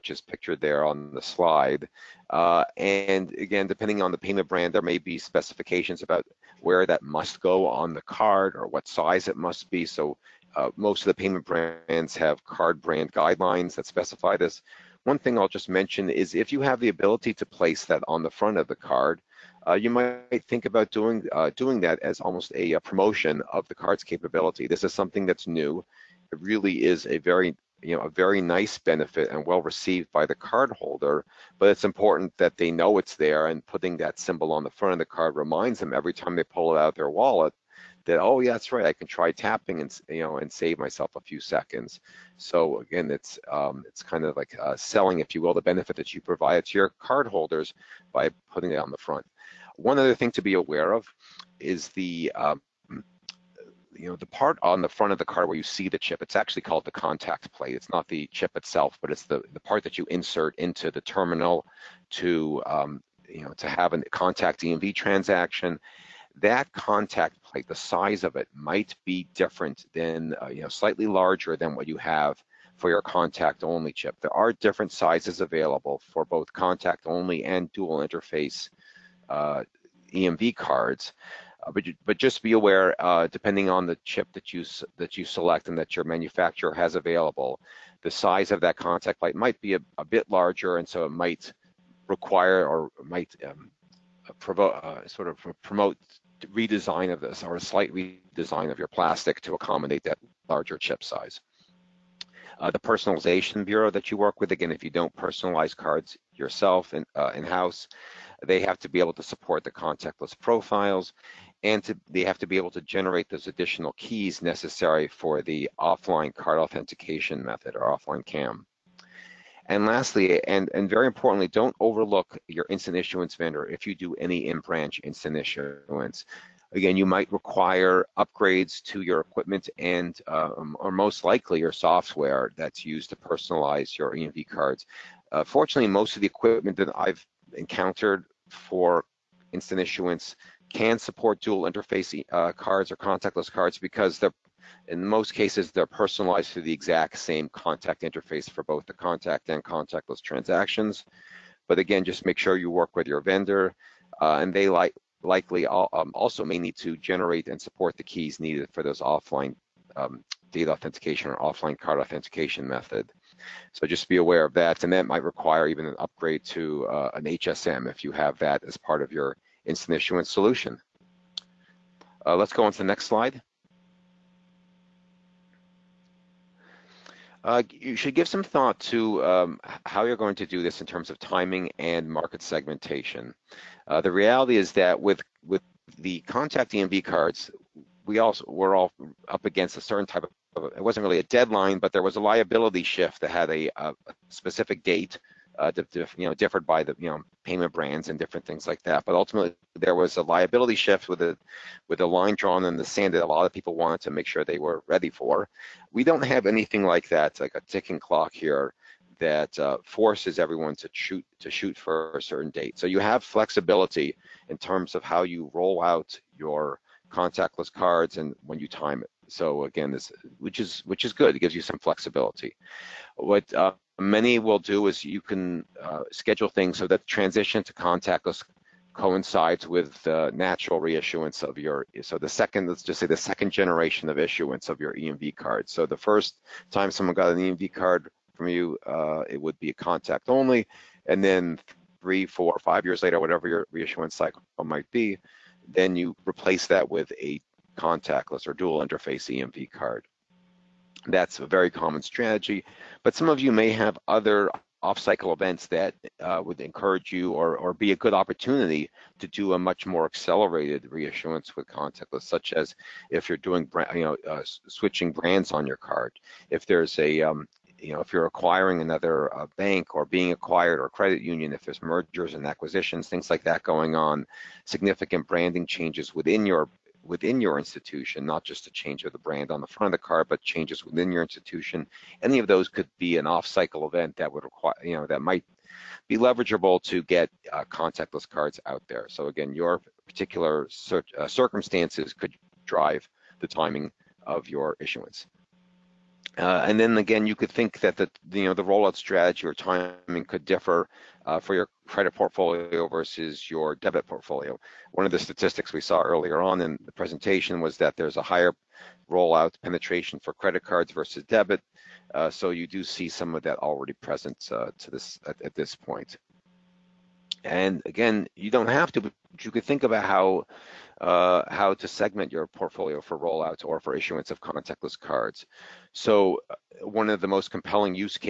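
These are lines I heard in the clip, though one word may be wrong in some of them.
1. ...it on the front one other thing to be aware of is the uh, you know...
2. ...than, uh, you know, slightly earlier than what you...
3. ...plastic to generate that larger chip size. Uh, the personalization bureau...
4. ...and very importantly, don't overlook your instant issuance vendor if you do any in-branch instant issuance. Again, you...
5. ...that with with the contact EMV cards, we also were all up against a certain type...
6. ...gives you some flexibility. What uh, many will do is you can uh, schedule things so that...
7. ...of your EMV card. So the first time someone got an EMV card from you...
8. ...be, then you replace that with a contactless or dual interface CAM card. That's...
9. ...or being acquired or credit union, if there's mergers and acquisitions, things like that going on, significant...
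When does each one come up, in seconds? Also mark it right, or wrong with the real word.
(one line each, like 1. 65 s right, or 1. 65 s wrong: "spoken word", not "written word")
1. 48 s right
2. 69 s wrong: "larger", not "earlier"
3. 98 s wrong: "accommodate", not "generate"
4. 120 s right
5. 184 s right
6. 221 s right
7. 234 s right
8. 244 s wrong: "EMV", not "CAM"
9. 269 s right.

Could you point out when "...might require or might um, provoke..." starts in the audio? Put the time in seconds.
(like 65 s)
91 s.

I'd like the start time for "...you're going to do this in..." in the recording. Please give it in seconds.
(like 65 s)
180 s.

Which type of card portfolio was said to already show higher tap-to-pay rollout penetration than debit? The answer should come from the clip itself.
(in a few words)
credit cards.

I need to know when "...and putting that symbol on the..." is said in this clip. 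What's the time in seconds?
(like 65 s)
33 s.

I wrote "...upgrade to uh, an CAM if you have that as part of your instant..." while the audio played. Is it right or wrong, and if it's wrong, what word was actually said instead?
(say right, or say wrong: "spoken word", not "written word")
wrong: "HSM", not "CAM".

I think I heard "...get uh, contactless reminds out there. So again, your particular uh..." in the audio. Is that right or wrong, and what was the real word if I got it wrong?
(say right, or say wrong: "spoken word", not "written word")
wrong: "cards", not "reminds".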